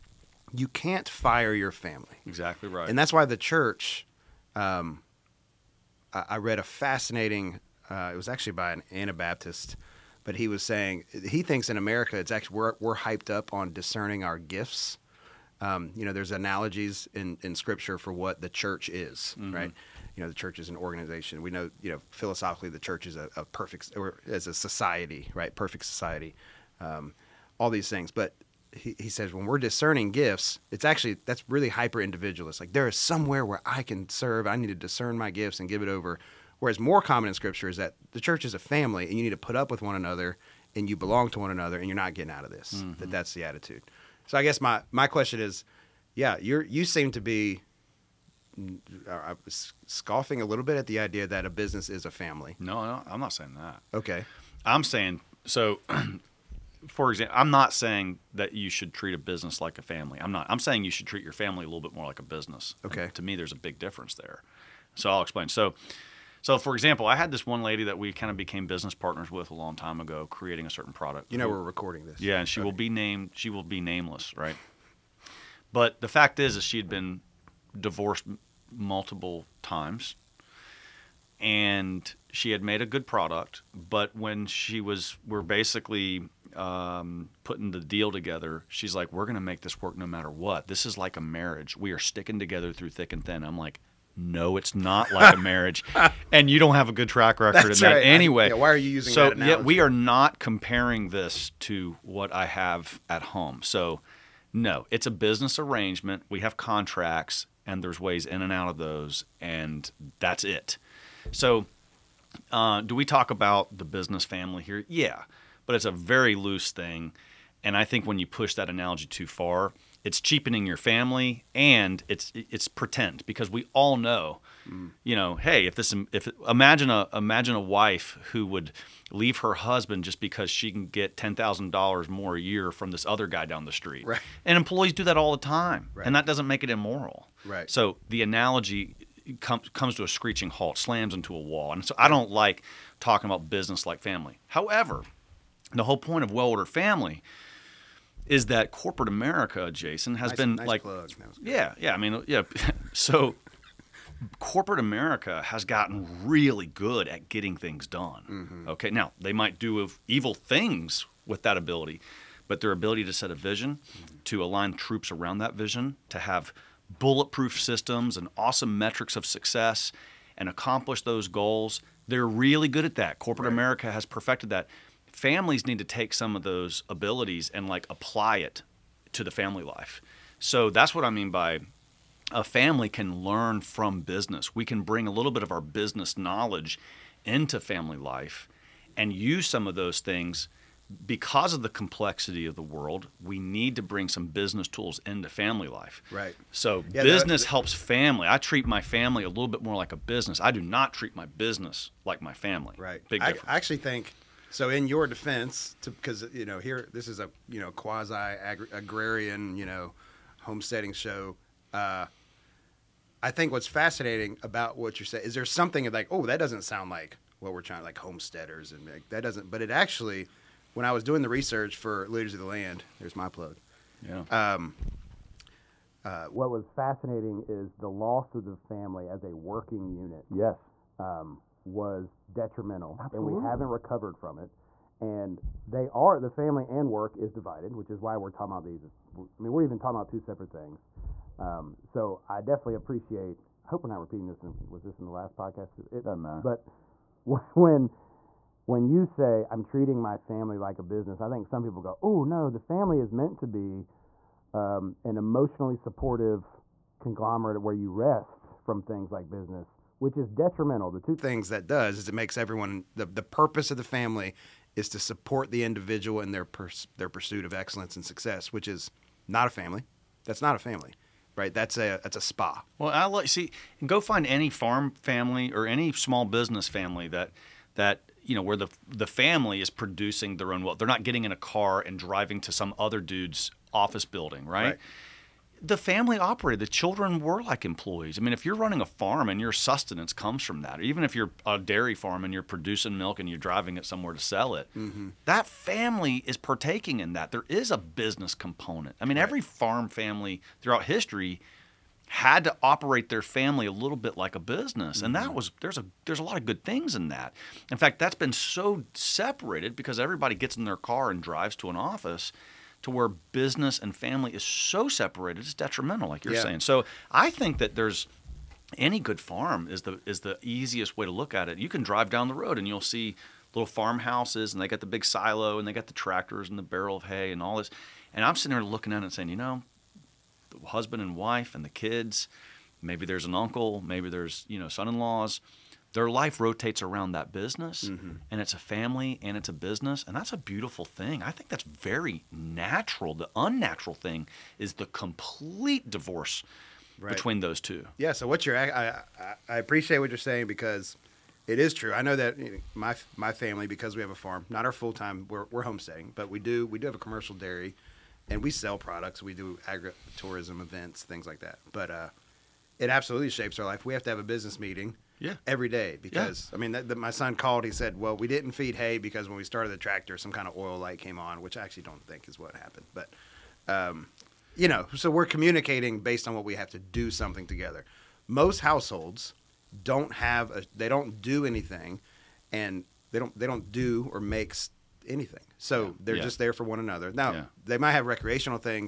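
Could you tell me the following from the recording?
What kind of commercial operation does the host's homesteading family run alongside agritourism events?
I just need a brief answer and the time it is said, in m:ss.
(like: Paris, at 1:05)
A dairy, at 5:56.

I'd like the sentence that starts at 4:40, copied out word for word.
They're not getting in a car and driving to some other dude's office building, right.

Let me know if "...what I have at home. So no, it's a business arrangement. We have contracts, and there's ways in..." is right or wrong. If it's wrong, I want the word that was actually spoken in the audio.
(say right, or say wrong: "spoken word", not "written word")
right.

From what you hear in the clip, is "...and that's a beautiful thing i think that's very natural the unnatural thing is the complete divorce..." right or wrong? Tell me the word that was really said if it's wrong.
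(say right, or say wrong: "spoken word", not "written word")
right.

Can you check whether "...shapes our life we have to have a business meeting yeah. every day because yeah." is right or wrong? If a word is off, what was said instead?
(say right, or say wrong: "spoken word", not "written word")
right.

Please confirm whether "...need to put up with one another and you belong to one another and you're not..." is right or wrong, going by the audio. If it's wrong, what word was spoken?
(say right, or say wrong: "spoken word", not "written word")
right.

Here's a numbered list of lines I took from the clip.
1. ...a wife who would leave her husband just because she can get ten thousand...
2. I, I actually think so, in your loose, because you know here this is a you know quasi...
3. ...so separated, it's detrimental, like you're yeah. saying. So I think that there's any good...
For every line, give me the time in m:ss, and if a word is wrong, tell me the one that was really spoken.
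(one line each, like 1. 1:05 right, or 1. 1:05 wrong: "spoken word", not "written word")
1. 2:07 right
2. 3:23 wrong: "defense", not "loose"
3. 5:14 right.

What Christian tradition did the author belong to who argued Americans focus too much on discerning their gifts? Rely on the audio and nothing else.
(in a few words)
Anabaptist.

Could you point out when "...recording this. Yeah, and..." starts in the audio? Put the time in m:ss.
1:11.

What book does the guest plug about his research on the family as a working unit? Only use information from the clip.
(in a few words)
Liturgy of the Land.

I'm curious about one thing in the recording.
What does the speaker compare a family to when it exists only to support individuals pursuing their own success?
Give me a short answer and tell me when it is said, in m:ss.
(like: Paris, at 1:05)
A spa, at 4:32.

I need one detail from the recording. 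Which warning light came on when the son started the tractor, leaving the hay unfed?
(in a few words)
Oil light.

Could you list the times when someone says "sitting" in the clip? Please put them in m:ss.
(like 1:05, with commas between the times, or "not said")
5:28.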